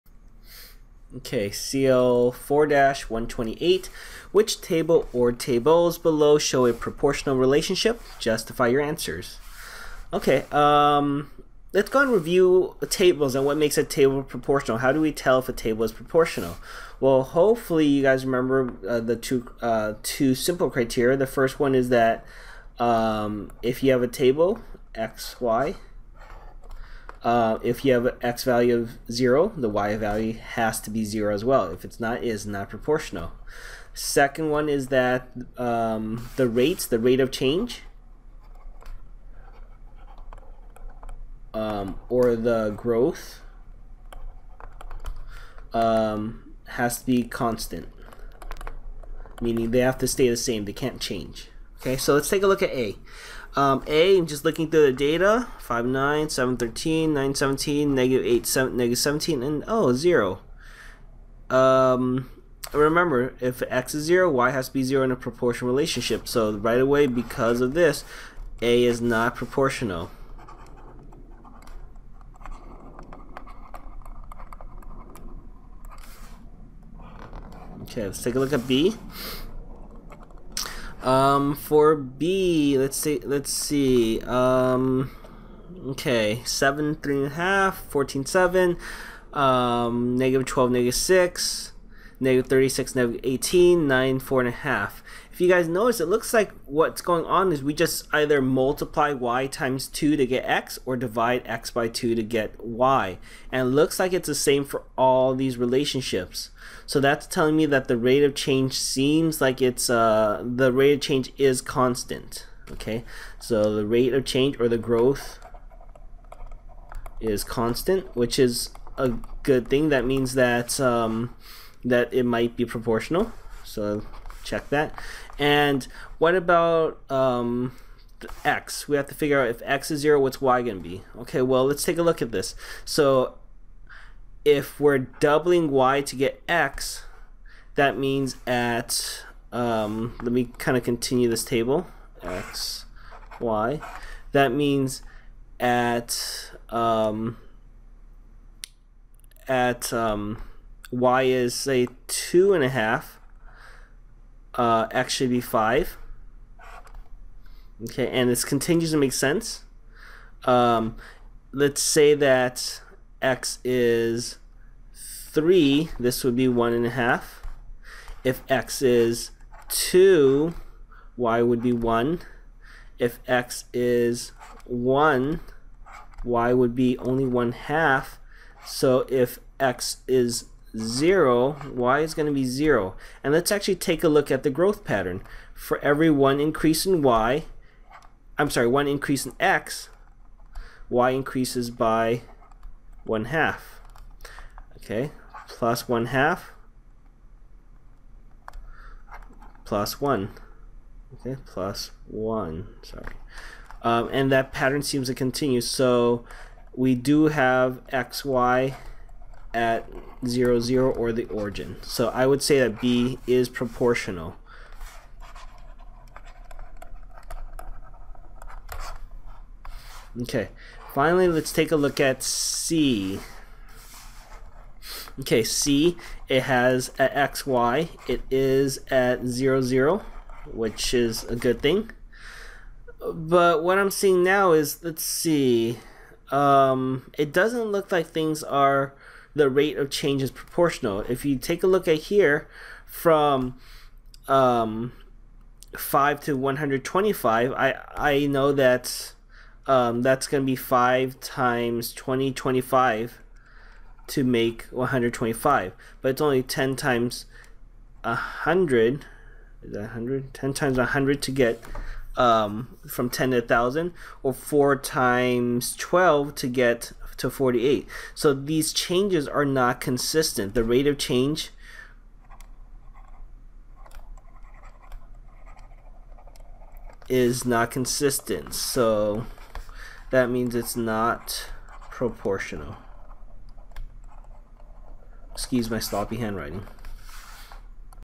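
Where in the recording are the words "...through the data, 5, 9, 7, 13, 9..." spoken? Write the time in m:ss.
0:54.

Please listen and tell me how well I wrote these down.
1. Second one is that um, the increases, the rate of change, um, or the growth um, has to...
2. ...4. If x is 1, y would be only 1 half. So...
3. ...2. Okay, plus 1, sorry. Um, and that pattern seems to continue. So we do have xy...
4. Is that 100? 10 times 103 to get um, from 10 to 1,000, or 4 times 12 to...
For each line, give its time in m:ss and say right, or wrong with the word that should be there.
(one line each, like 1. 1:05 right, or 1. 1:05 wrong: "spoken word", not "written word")
1. 0:33 wrong: "rates", not "increases"
2. 2:51 wrong: "1", not "4"
3. 3:20 wrong: "1", not "2"
4. 4:19 wrong: "100", not "103".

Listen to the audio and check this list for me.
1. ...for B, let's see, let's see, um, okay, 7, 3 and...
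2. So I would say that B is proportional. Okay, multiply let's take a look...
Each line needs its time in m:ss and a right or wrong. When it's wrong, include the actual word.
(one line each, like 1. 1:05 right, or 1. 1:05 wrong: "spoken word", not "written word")
1. 1:21 right
2. 3:31 wrong: "finally", not "multiply".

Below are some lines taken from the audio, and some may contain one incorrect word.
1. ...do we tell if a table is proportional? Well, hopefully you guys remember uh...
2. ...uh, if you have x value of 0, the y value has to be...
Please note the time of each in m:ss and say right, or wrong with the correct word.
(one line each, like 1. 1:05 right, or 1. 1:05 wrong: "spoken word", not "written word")
1. 0:14 right
2. 0:27 right.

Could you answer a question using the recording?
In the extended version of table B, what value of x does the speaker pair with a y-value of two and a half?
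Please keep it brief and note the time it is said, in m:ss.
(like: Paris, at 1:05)
5, at 2:34.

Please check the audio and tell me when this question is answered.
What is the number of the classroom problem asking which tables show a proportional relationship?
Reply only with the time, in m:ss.
0:01.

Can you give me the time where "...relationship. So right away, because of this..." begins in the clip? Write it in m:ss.
1:05.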